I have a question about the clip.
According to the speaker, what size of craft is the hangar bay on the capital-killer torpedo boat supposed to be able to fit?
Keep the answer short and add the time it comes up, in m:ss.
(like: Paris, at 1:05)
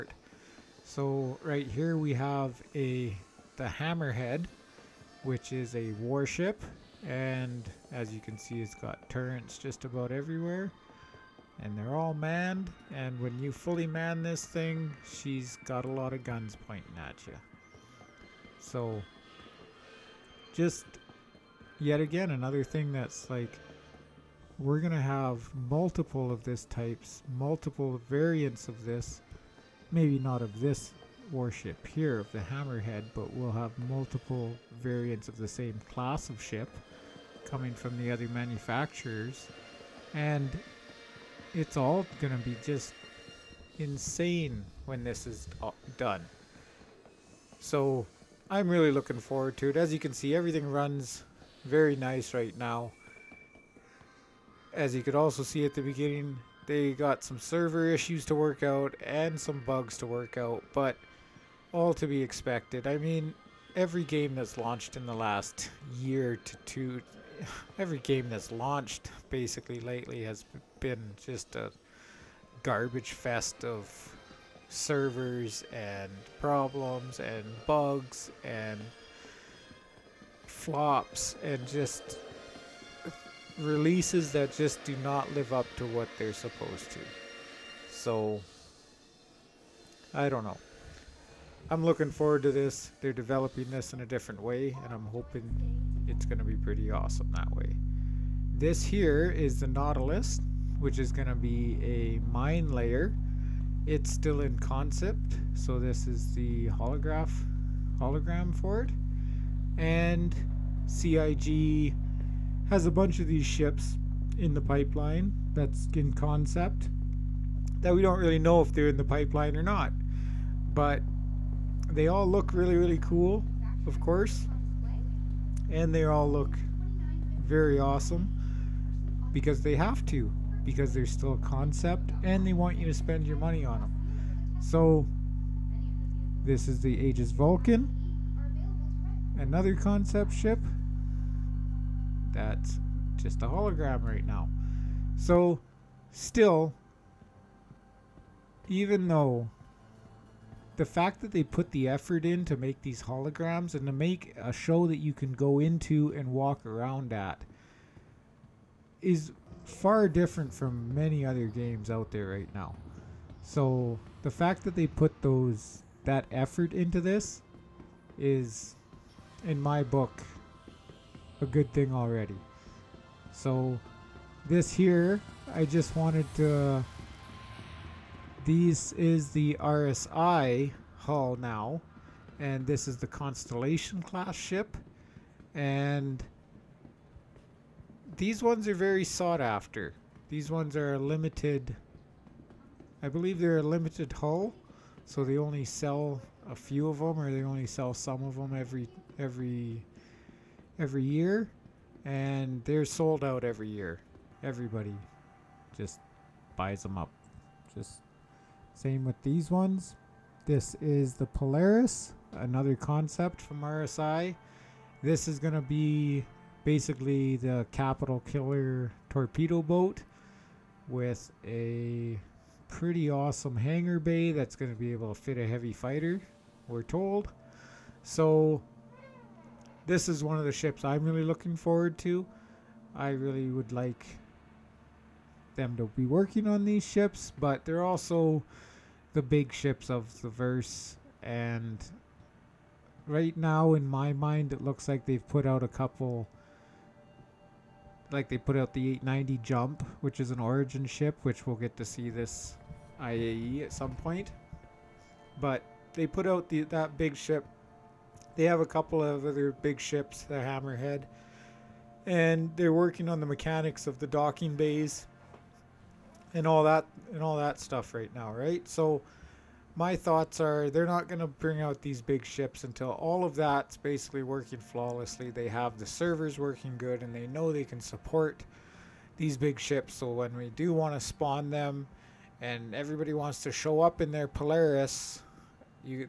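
A heavy fighter, at 3:45.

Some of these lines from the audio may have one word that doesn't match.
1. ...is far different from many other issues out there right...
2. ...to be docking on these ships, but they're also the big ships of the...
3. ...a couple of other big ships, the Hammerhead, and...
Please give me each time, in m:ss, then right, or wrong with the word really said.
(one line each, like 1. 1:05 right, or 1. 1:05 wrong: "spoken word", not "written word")
1. 2:38 wrong: "games", not "issues"
2. 3:55 wrong: "working", not "docking"
3. 4:18 right.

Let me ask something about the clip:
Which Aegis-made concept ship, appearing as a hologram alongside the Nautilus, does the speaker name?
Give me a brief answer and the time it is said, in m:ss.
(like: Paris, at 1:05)
Aegis Vulcan, at 2:16.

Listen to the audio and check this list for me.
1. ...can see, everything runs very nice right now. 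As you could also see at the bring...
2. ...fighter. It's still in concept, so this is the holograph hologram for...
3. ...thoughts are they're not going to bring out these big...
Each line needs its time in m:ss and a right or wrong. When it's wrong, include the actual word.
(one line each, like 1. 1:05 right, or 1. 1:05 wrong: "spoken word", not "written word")
1. 0:49 wrong: "beginning", not "bring"
2. 1:42 wrong: "layer", not "fighter"
3. 4:29 right.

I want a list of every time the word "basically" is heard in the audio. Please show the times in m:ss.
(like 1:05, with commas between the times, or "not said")
1:09, 3:36, 4:33.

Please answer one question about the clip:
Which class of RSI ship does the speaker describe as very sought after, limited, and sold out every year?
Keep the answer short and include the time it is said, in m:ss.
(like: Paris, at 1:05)
Constellation, at 3:03.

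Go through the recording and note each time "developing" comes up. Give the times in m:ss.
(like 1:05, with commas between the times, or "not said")
1:33.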